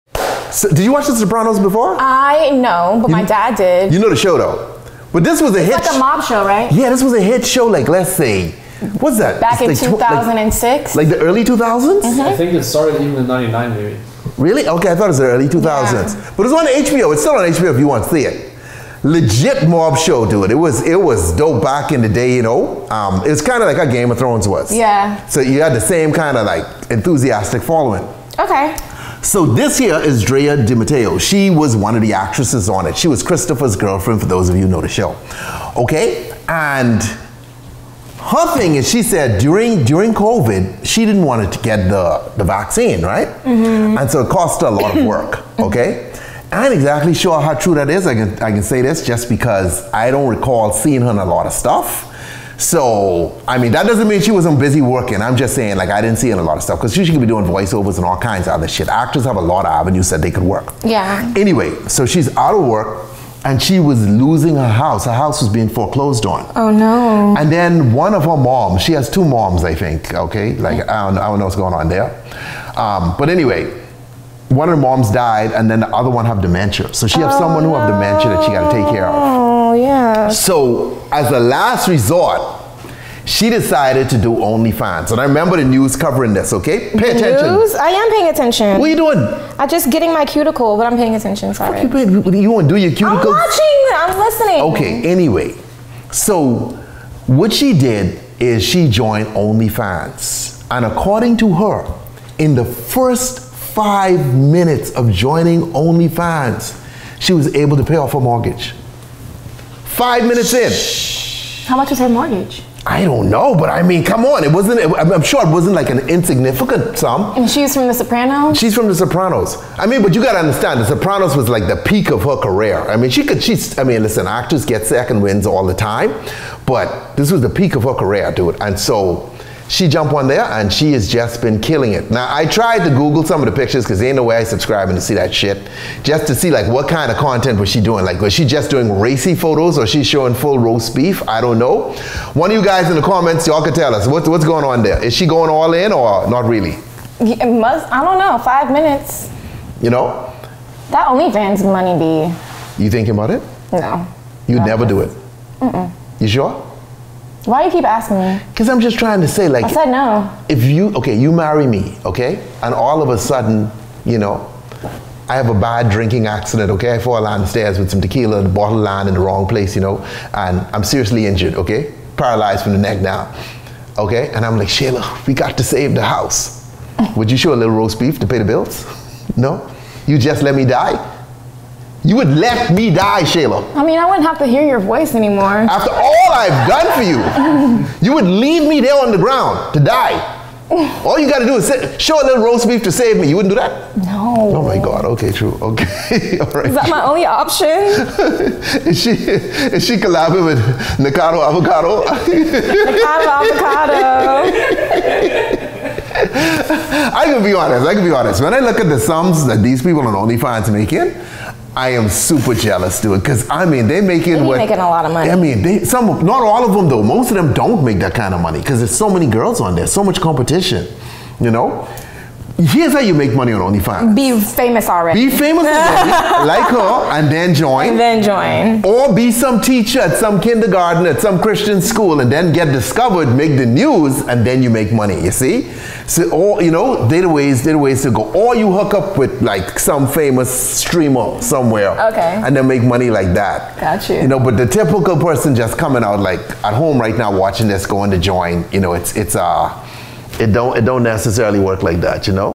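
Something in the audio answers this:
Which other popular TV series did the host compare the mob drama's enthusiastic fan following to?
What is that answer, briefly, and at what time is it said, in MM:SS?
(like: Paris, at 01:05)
Game of Thrones, at 00:23.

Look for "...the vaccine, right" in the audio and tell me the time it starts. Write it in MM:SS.
00:42.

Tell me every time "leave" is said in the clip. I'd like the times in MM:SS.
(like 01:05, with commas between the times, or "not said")
03:08.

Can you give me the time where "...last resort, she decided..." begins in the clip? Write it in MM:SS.
01:21.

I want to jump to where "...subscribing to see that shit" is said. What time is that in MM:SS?
02:14.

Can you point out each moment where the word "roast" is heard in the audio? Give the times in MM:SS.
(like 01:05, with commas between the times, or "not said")
02:20, 02:57, 03:12.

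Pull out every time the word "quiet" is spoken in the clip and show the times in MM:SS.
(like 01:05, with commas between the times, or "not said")
not said.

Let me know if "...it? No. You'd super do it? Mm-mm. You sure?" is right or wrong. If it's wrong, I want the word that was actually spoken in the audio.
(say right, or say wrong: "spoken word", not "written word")
wrong: "never", not "super".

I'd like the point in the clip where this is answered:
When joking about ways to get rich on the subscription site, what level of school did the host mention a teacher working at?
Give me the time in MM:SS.
03:50.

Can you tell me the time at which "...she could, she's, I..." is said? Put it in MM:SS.
02:03.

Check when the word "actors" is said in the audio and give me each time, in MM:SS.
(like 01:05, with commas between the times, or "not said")
00:58, 02:04.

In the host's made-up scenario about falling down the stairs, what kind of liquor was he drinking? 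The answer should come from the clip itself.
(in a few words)
Tequila.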